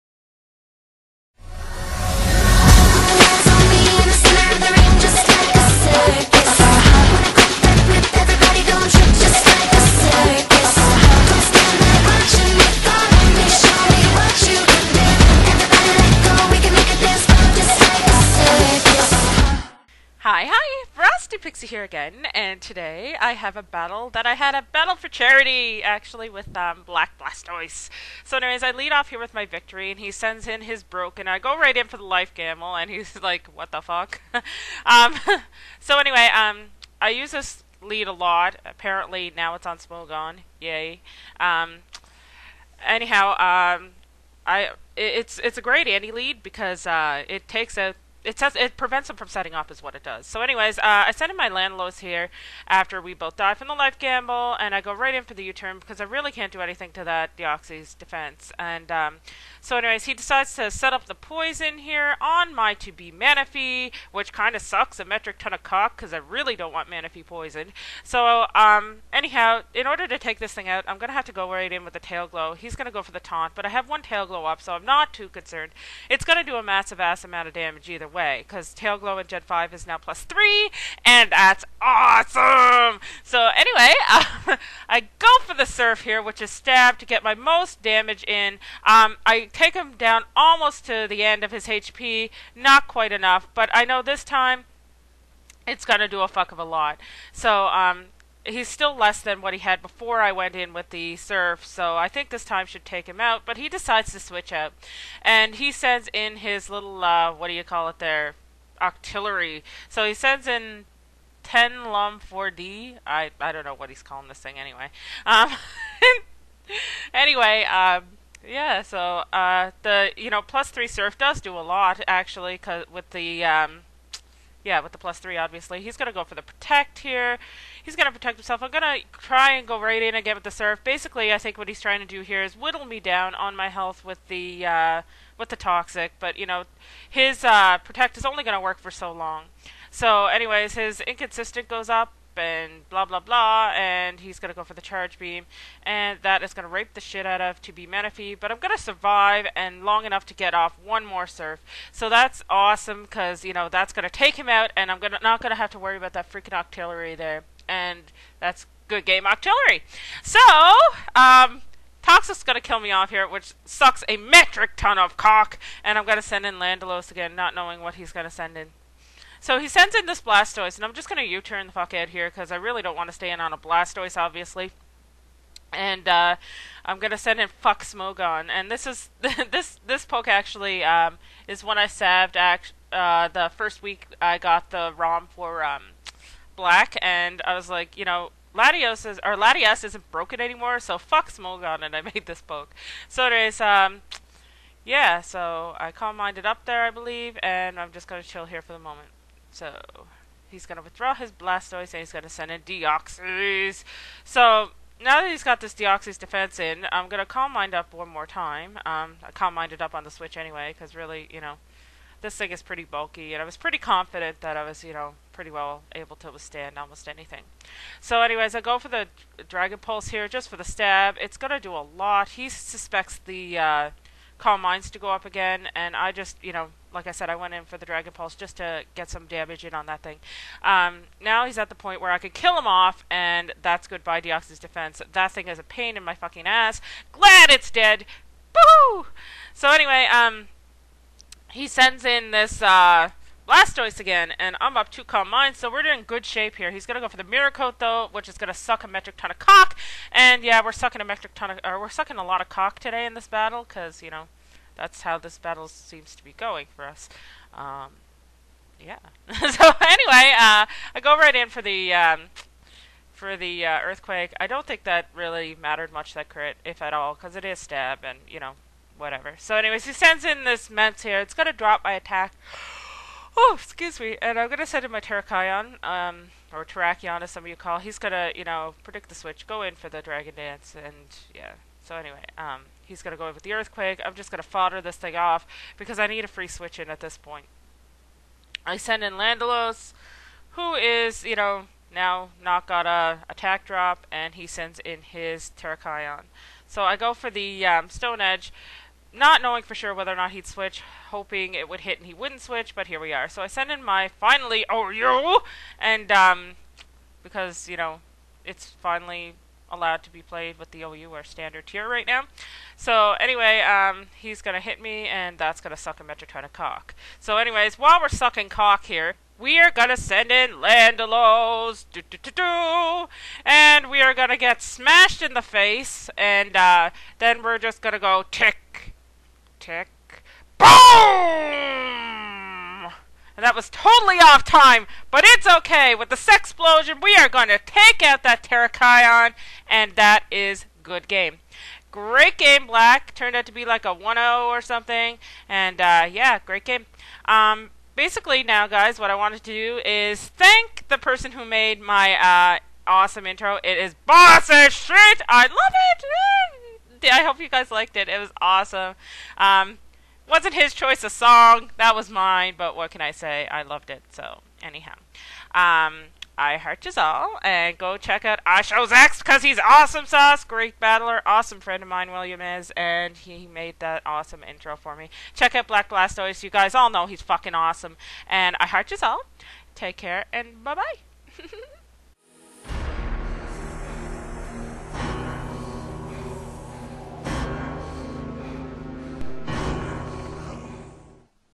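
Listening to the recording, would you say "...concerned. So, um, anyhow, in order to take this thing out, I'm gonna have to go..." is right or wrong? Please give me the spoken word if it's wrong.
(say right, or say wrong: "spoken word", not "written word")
wrong: "poisoned", not "concerned".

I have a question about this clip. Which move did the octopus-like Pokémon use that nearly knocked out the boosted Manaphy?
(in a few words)
Charge Beam.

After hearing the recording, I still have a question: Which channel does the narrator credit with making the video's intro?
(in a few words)
iShowZx.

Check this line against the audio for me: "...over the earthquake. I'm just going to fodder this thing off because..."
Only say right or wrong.
right.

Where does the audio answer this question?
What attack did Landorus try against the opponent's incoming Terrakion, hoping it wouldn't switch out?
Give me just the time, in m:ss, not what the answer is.
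4:57.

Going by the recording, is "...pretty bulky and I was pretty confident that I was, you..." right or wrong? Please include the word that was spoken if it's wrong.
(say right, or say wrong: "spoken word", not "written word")
right.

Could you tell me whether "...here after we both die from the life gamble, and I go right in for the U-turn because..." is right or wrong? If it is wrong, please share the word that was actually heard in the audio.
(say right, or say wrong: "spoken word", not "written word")
right.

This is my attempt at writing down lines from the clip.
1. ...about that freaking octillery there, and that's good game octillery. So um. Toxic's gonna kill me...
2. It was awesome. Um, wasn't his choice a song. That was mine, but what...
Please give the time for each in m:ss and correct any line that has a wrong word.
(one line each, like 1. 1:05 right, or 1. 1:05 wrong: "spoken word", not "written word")
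1. 2:35 right
2. 5:58 right.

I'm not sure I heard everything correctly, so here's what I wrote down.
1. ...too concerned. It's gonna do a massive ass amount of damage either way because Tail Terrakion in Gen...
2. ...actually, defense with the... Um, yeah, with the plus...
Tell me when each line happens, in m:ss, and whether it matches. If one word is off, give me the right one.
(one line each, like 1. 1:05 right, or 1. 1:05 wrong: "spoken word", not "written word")
1. 1:15 wrong: "Glow", not "Terrakion"
2. 2:02 wrong: "cause", not "defense".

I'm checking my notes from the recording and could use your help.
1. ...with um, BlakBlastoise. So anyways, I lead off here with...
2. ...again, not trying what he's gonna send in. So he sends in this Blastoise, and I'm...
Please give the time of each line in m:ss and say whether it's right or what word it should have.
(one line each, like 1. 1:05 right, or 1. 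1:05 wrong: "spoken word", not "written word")
1. 0:26 right
2. 2:47 wrong: "knowing", not "trying".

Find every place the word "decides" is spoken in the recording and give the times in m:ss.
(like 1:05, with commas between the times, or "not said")
1:00, 1:43.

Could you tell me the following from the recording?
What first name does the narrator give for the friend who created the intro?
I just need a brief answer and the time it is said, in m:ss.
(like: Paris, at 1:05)
William, at 6:12.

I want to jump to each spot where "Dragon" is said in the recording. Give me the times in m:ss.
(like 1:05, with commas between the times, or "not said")
3:39, 3:47, 4:40.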